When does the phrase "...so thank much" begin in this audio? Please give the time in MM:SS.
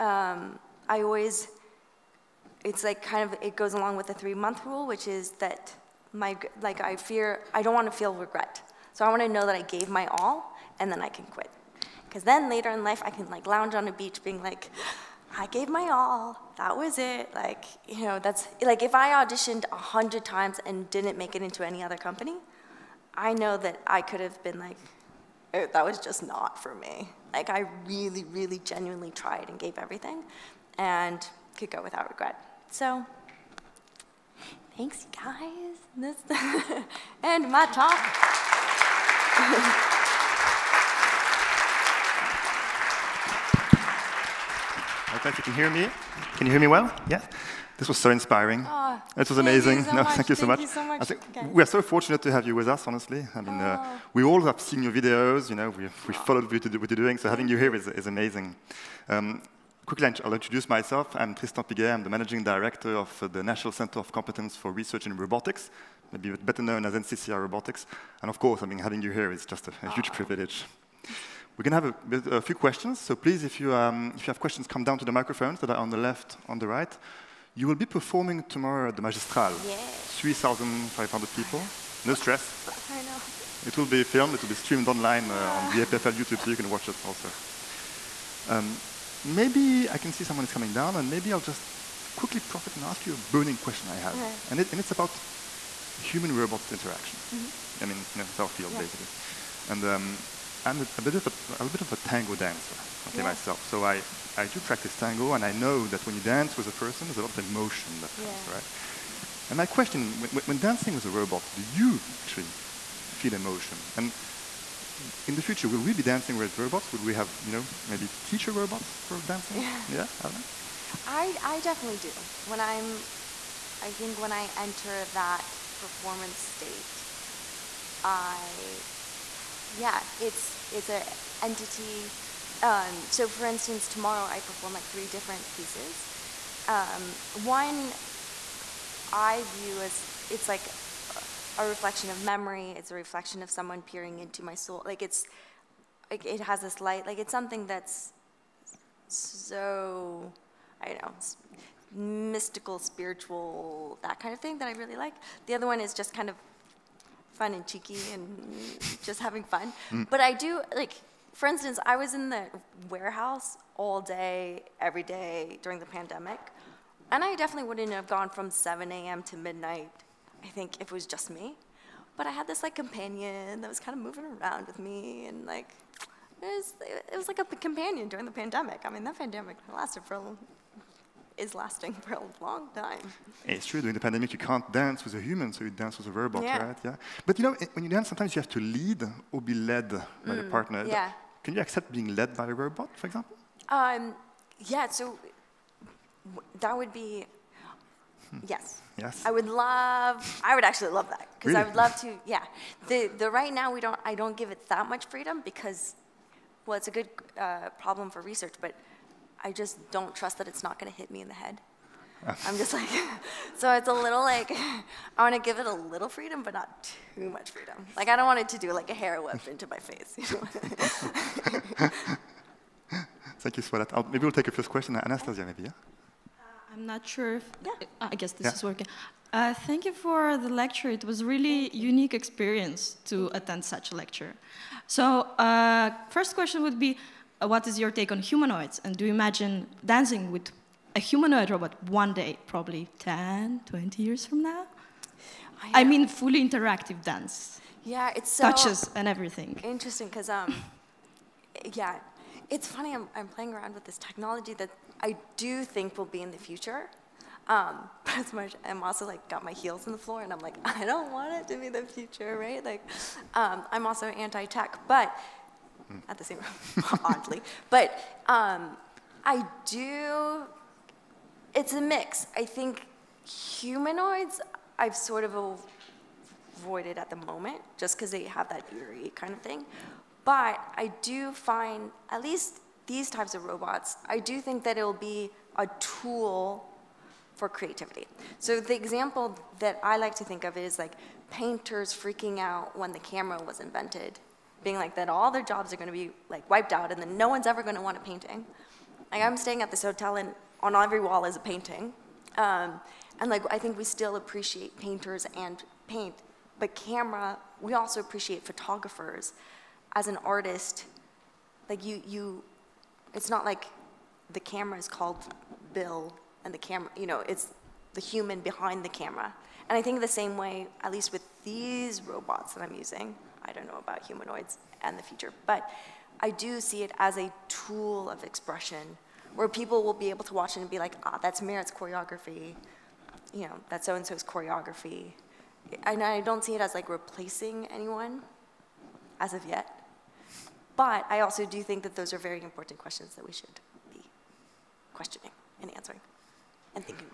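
00:50.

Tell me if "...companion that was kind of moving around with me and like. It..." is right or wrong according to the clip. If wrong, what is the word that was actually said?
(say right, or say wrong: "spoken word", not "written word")
right.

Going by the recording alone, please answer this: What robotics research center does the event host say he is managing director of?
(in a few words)
NCCR Robotics.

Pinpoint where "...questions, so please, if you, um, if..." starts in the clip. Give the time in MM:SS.
01:12.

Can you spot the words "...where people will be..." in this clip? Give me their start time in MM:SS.
05:29.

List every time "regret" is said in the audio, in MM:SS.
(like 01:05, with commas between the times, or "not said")
00:08, 00:32.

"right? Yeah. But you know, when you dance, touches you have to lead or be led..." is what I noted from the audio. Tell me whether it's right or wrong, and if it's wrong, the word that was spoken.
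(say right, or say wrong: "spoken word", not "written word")
wrong: "sometimes", not "touches".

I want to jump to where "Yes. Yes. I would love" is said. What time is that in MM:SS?
03:18.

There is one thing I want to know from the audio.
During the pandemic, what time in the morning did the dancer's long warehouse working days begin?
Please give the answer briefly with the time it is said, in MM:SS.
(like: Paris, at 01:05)
7 a.m., at 02:48.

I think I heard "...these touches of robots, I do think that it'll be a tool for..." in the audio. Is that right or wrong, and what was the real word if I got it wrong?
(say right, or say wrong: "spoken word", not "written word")
wrong: "types", not "touches".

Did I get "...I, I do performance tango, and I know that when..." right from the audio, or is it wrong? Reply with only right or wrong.
wrong.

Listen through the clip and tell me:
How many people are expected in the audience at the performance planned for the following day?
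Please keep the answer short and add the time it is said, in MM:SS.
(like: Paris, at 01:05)
3,500, at 01:20.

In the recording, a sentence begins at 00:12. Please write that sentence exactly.
Because then later in life, I can like lounge on a beach being like, I gave my all.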